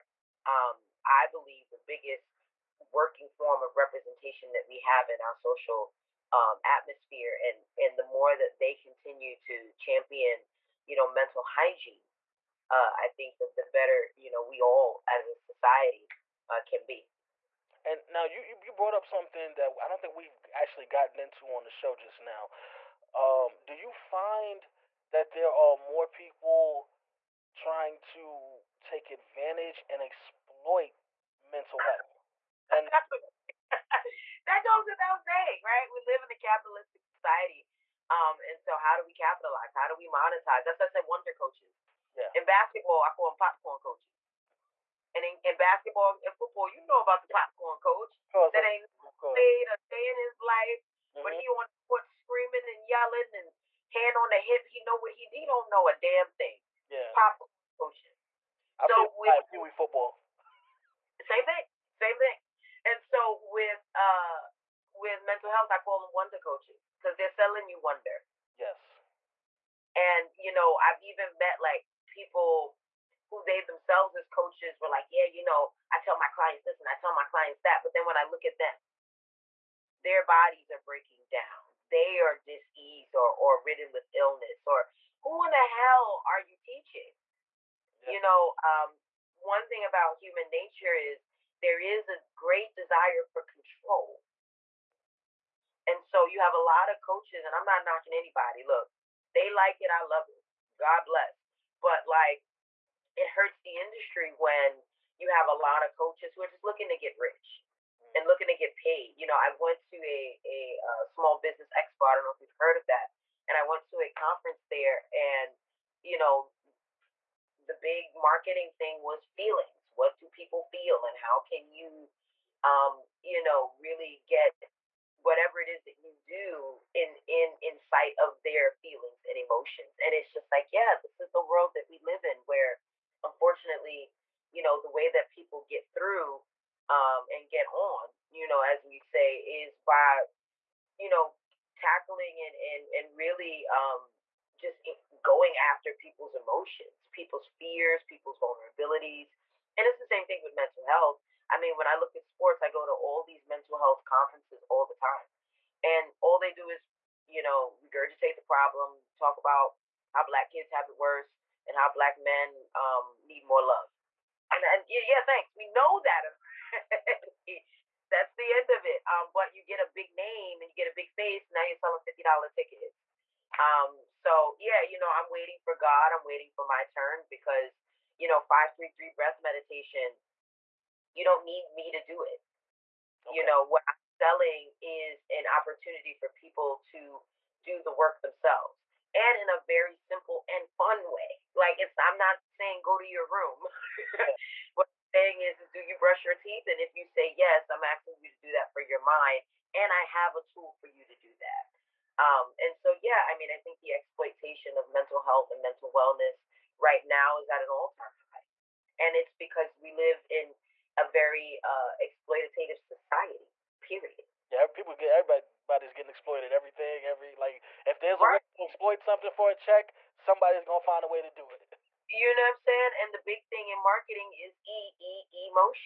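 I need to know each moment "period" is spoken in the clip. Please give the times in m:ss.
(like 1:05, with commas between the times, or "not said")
3:33.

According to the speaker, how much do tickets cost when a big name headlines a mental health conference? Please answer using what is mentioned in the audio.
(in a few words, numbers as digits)
$50.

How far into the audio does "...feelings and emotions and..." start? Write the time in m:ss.
2:08.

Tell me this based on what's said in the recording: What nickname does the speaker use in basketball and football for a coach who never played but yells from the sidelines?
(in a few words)
popcorn coaches.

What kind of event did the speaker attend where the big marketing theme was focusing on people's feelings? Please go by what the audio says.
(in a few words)
small business expo.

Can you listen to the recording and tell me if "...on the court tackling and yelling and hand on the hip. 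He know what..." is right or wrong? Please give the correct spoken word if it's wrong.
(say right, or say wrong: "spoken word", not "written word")
wrong: "screaming", not "tackling".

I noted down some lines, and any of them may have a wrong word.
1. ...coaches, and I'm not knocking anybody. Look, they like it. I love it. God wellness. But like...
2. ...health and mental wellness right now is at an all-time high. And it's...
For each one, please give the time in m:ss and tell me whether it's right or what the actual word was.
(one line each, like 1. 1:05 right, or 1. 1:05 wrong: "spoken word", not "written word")
1. 1:37 wrong: "bless", not "wellness"
2. 3:25 right.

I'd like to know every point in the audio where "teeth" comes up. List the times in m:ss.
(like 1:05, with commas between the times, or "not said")
3:16.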